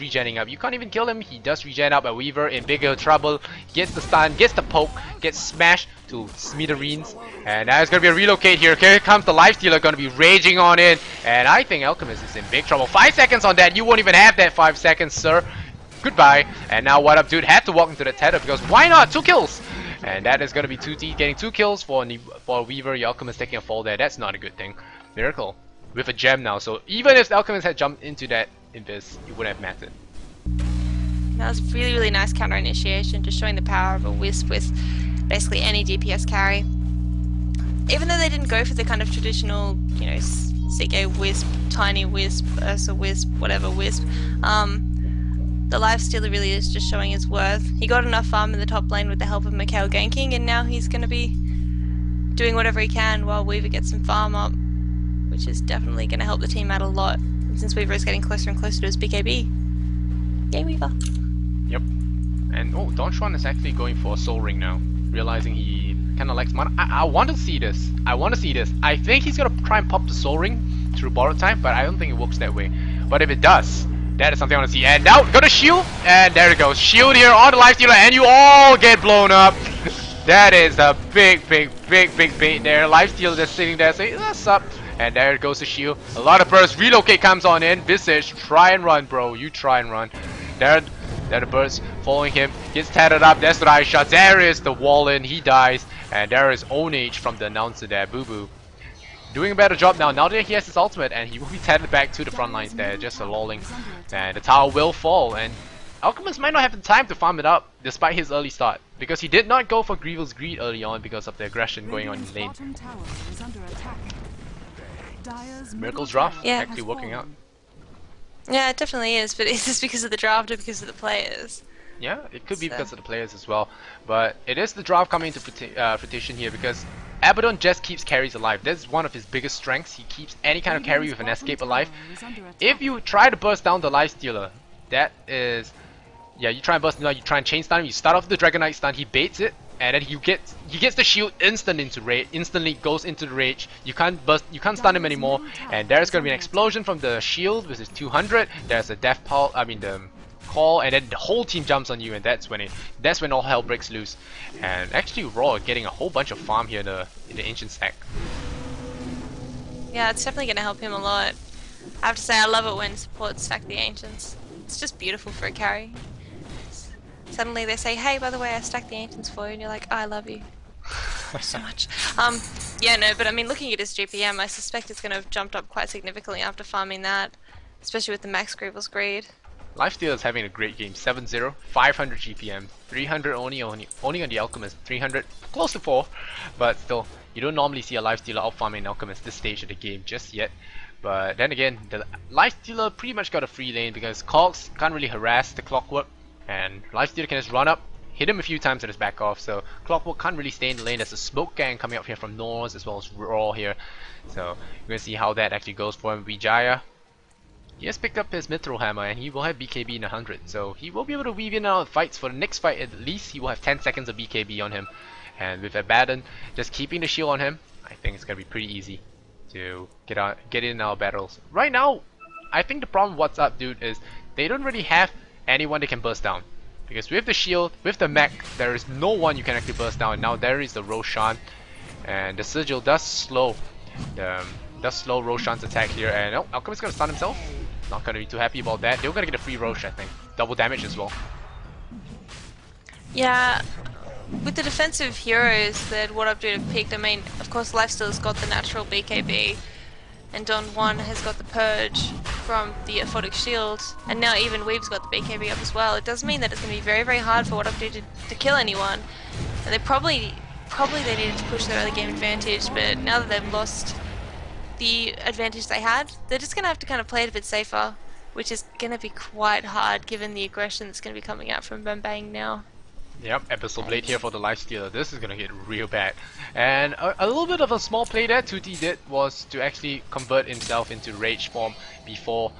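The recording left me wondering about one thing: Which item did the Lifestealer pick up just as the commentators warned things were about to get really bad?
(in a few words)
Abyssal Blade.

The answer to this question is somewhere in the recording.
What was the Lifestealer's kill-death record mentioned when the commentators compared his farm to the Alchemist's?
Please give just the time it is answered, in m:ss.
3:00.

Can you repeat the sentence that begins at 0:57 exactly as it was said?
since Weaver is getting closer and closer to his BKB.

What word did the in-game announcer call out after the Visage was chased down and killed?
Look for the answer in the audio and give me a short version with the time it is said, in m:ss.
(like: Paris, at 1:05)
Ownage, at 1:36.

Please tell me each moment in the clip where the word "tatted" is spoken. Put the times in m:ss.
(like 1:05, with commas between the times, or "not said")
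1:32, 1:41.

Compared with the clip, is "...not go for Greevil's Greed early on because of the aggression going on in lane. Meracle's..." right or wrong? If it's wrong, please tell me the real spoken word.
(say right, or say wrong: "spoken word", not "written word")
right.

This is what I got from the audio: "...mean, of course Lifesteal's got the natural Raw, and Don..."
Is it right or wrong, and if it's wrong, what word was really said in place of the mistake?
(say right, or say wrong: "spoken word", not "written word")
wrong: "BKB", not "Raw".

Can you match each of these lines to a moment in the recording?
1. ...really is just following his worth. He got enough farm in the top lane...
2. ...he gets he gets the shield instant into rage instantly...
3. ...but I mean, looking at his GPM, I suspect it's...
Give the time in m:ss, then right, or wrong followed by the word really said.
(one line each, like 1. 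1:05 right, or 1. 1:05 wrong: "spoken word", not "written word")
1. 0:46 wrong: "showing", not "following"
2. 2:20 right
3. 2:53 right.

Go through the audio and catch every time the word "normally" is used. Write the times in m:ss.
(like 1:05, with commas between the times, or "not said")
3:07.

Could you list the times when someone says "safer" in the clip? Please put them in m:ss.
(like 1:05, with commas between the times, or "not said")
4:27.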